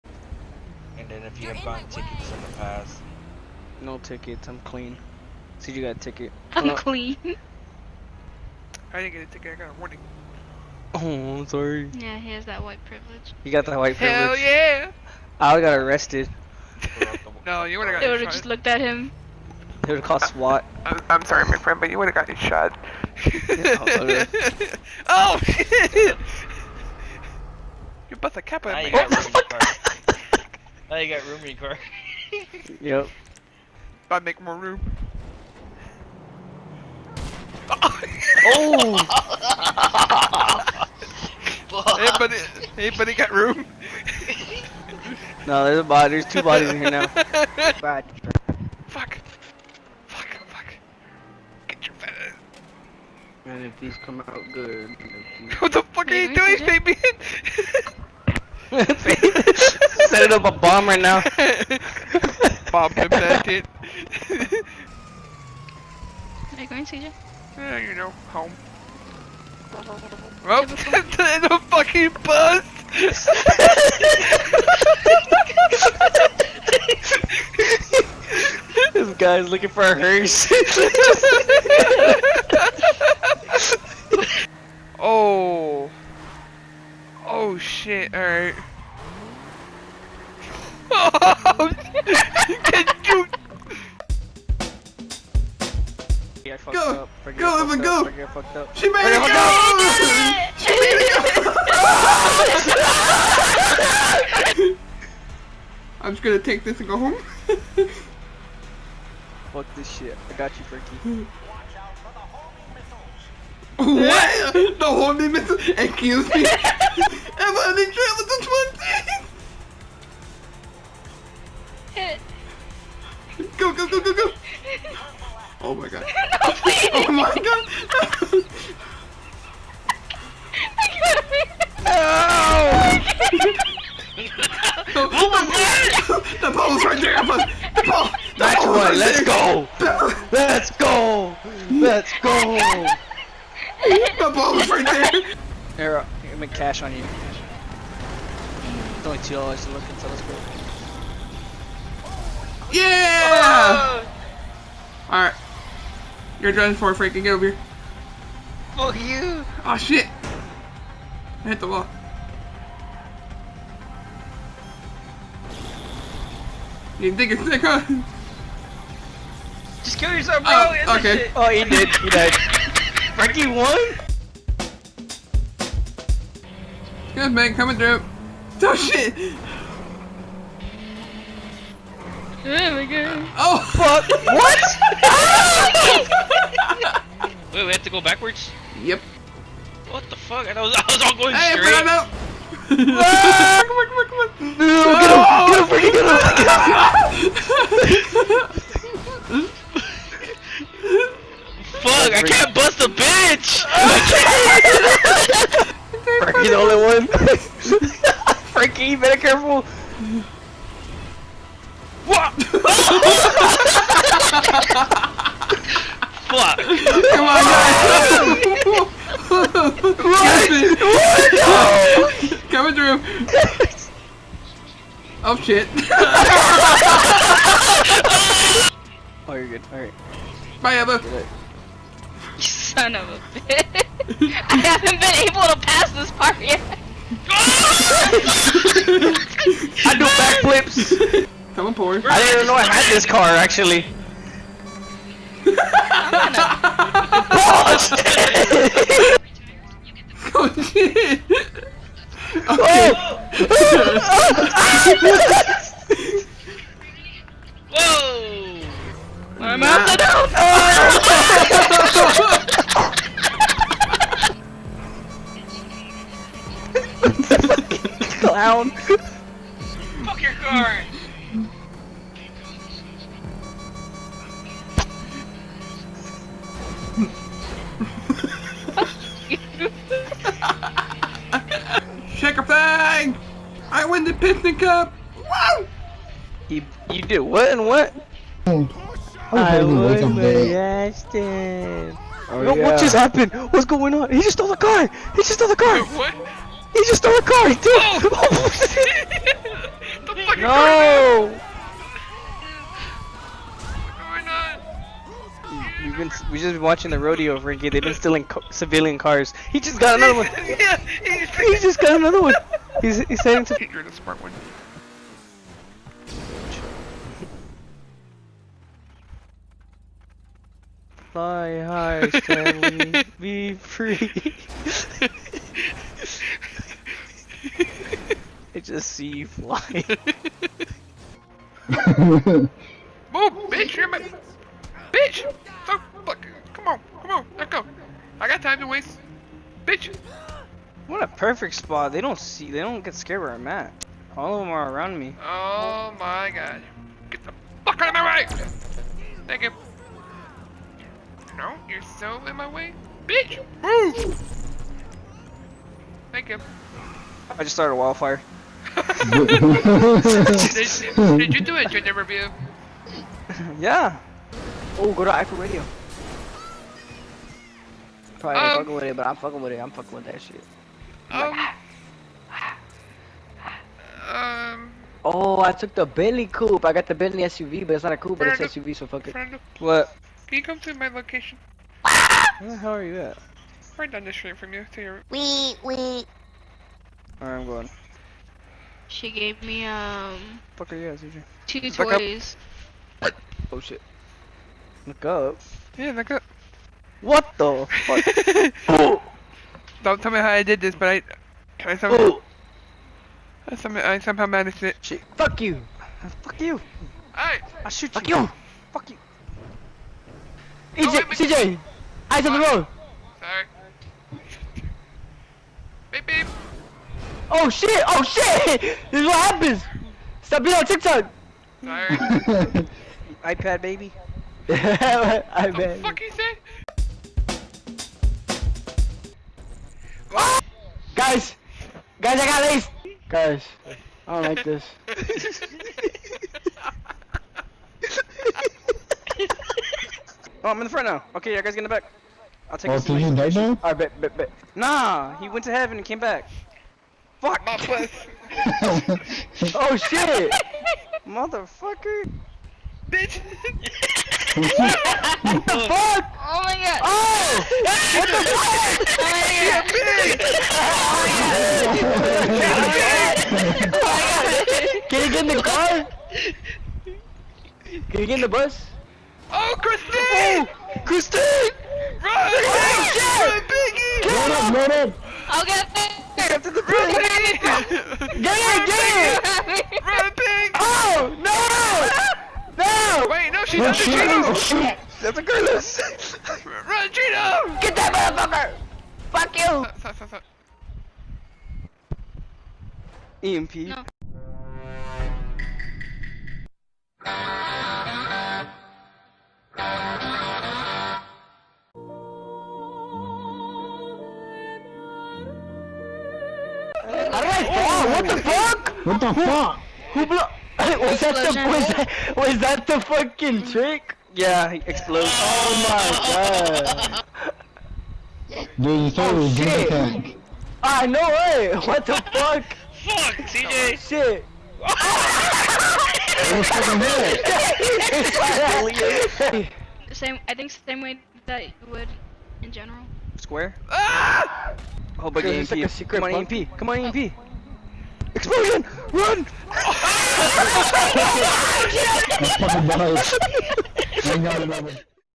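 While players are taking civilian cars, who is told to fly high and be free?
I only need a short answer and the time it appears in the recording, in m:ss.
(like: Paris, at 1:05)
Stanley, at 5:22.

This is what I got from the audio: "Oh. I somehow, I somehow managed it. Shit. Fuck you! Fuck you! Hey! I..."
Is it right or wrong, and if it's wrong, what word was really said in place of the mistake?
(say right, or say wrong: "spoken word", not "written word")
right.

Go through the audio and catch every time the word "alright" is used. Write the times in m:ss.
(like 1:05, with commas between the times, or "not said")
1:28, 3:49, 6:27.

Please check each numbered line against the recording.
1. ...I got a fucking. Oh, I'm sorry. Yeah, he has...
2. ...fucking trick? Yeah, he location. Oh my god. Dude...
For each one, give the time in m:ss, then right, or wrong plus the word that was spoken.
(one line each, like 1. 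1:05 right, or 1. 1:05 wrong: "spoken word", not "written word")
1. 0:09 wrong: "warning", not "fucking"
2. 8:32 wrong: "explosion", not "location".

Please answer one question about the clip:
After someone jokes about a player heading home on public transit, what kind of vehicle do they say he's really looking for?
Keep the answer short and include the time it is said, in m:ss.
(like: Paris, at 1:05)
A hearse, at 1:19.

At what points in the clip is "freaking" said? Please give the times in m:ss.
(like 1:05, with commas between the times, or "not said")
2:36, 3:17.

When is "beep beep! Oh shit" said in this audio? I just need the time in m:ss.
6:55.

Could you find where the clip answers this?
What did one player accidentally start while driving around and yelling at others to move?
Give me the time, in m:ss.
5:57.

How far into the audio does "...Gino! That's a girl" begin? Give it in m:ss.
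8:04.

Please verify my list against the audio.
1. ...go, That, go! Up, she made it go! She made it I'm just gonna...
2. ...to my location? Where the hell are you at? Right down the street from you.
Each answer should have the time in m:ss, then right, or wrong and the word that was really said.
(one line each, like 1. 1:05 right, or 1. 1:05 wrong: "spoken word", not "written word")
1. 1:37 wrong: "Evan", not "That"
2. 6:20 right.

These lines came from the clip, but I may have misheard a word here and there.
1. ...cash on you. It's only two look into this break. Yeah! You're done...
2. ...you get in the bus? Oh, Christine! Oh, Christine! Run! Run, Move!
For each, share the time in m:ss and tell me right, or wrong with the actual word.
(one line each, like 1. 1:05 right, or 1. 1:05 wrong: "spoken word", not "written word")
1. 2:26 right
2. 7:48 wrong: "Biggie", not "Move".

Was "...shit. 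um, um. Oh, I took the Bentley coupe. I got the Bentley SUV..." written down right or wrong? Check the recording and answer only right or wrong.
right.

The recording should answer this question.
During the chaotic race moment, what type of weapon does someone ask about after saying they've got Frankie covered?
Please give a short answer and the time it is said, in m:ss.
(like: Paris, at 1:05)
Homing missile, at 1:54.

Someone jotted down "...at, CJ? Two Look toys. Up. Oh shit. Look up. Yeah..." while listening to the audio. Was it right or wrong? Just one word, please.
right.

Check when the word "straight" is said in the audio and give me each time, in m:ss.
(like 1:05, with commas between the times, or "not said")
3:11.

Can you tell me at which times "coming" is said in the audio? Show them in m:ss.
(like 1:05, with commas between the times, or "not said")
2:57, 3:42.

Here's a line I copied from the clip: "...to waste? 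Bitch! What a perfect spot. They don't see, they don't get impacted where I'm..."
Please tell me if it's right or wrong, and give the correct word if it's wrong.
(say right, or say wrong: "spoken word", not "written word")
wrong: "scared", not "impacted".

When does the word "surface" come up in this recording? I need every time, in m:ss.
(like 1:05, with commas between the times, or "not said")
not said.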